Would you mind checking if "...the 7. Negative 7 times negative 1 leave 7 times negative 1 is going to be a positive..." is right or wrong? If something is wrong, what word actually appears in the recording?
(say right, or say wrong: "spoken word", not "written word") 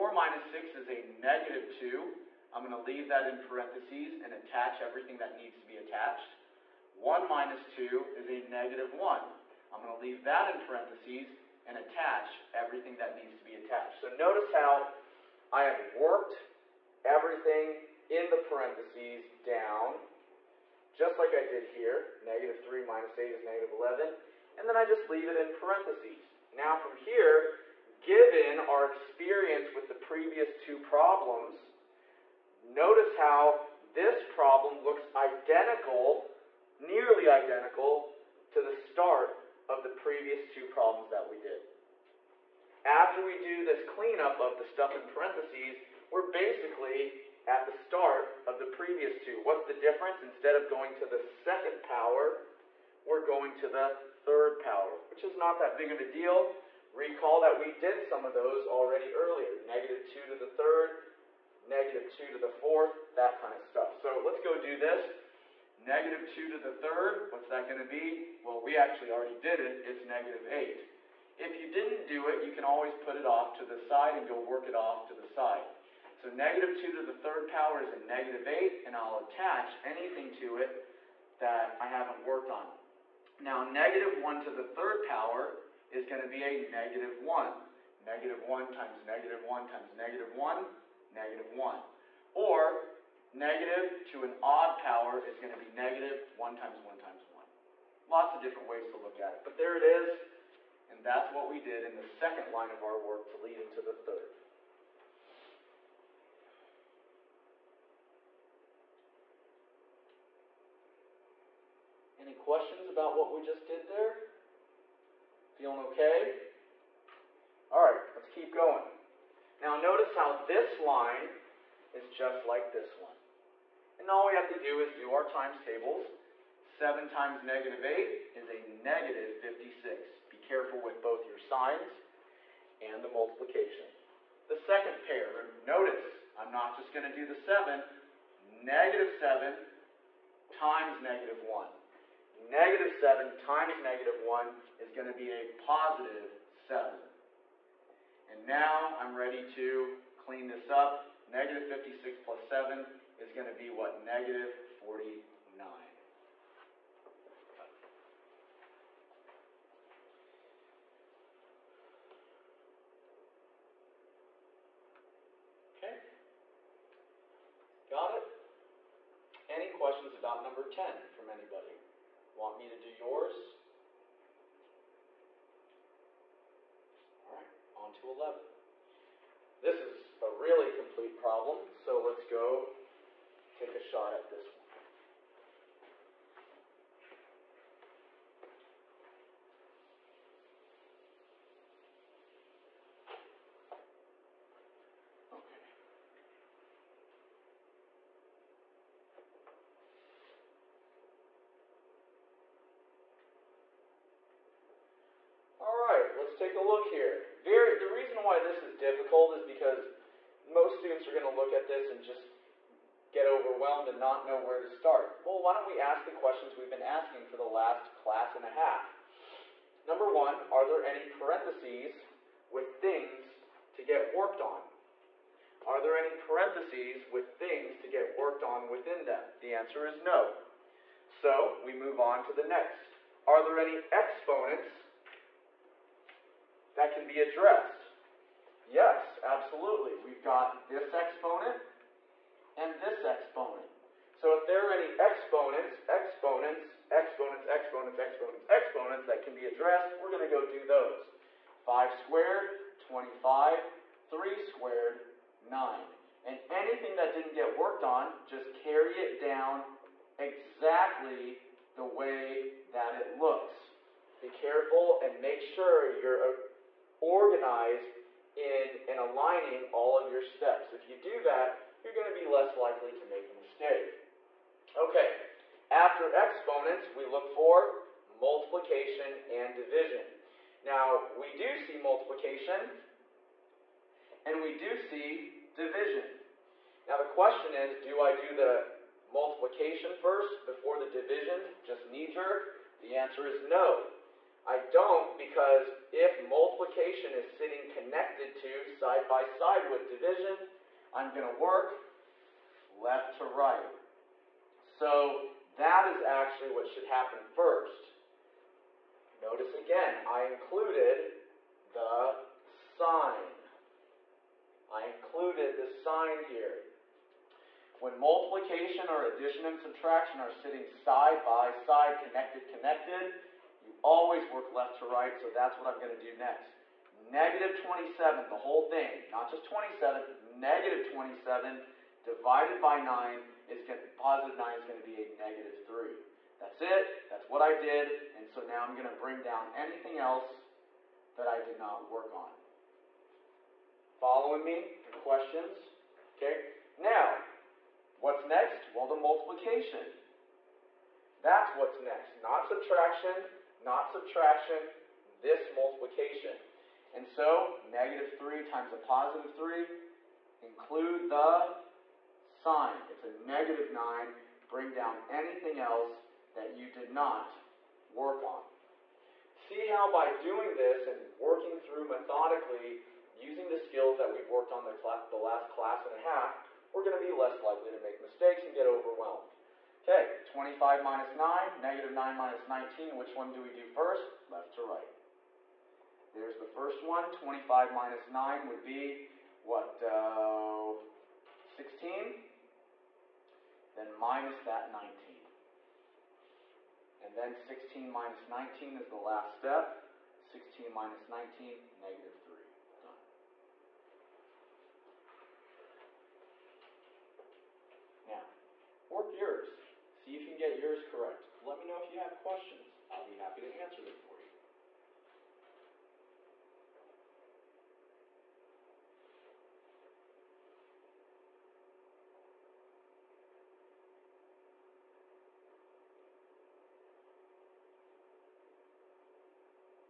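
wrong: "negative", not "leave".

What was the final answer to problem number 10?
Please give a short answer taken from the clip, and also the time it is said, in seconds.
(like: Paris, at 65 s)
-49, at 153 s.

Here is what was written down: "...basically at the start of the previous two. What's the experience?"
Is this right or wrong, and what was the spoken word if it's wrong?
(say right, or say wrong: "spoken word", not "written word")
wrong: "difference", not "experience".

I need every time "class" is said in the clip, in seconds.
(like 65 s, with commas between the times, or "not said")
218 s, 375 s.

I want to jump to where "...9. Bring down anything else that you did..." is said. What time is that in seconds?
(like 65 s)
363 s.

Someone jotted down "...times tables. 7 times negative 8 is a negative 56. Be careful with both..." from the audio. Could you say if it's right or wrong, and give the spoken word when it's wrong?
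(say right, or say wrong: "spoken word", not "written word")
right.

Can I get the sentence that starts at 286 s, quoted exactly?
Now, the question is, do I do the multiplication first before the division, just knee-jerk?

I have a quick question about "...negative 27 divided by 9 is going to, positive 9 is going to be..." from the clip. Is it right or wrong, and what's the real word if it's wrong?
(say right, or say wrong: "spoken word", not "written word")
right.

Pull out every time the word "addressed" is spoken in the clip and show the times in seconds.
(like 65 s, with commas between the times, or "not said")
237 s, 249 s.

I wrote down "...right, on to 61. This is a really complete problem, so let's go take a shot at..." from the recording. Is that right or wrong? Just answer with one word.
wrong.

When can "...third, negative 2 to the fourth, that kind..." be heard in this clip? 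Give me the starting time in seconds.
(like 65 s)
60 s.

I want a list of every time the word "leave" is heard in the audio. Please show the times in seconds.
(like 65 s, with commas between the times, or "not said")
2 s, 10 s, 25 s.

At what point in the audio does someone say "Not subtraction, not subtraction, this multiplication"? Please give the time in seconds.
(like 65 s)
352 s.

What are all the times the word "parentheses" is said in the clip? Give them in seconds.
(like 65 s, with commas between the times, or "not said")
3 s, 10 s, 18 s, 25 s, 45 s, 221 s, 226 s.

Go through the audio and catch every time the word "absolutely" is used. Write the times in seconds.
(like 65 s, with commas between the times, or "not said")
239 s.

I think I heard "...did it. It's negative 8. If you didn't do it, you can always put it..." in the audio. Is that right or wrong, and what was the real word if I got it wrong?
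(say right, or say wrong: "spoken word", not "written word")
right.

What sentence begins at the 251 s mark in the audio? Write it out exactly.
5 squared, 25, 3 squared, 9.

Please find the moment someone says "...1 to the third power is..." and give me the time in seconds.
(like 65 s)
84 s.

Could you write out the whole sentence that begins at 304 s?
So that is actually what should happen first.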